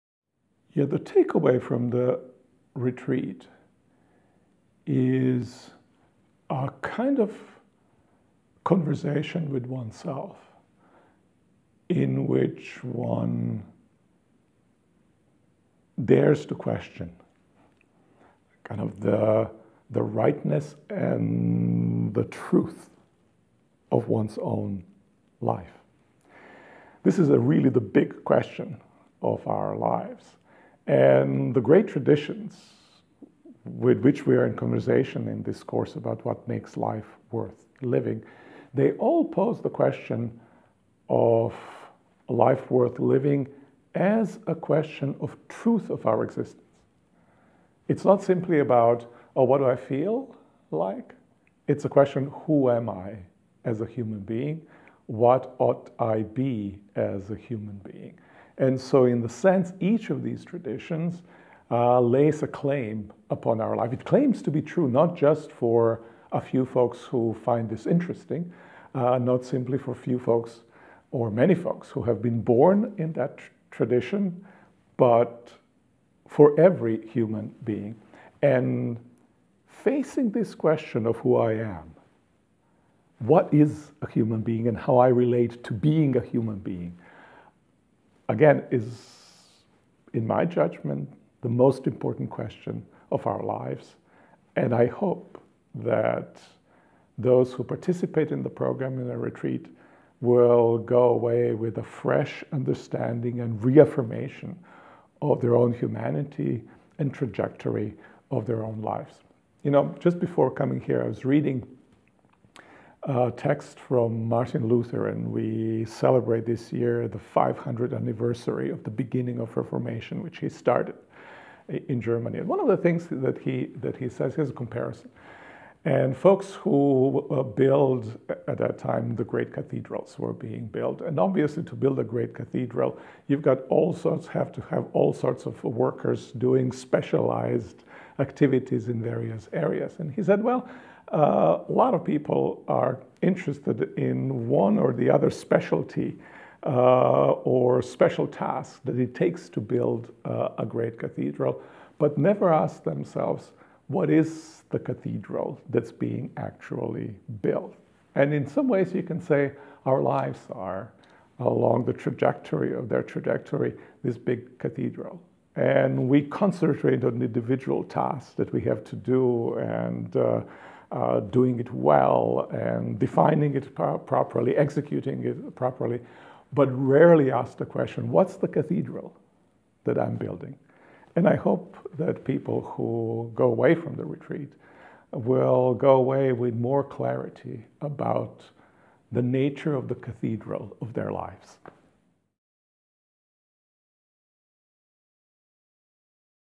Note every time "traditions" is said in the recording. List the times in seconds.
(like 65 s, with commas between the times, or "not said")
31 s, 60 s, 73 s.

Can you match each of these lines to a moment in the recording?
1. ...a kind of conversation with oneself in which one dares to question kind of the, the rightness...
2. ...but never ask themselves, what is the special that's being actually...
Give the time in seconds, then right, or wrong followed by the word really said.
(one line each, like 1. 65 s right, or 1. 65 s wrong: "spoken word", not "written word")
1. 6 s right
2. 151 s wrong: "cathedral", not "special".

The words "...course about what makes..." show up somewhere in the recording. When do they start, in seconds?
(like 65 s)
35 s.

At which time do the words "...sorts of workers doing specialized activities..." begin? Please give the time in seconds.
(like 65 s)
135 s.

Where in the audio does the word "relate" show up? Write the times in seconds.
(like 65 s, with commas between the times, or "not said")
85 s.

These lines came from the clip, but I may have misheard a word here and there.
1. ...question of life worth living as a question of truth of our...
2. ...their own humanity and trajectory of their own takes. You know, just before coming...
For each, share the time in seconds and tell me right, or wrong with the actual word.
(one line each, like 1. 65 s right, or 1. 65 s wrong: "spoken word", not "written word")
1. 39 s right
2. 105 s wrong: "lives", not "takes".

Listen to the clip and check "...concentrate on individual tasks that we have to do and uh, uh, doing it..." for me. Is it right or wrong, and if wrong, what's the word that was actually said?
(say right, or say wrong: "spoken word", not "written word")
right.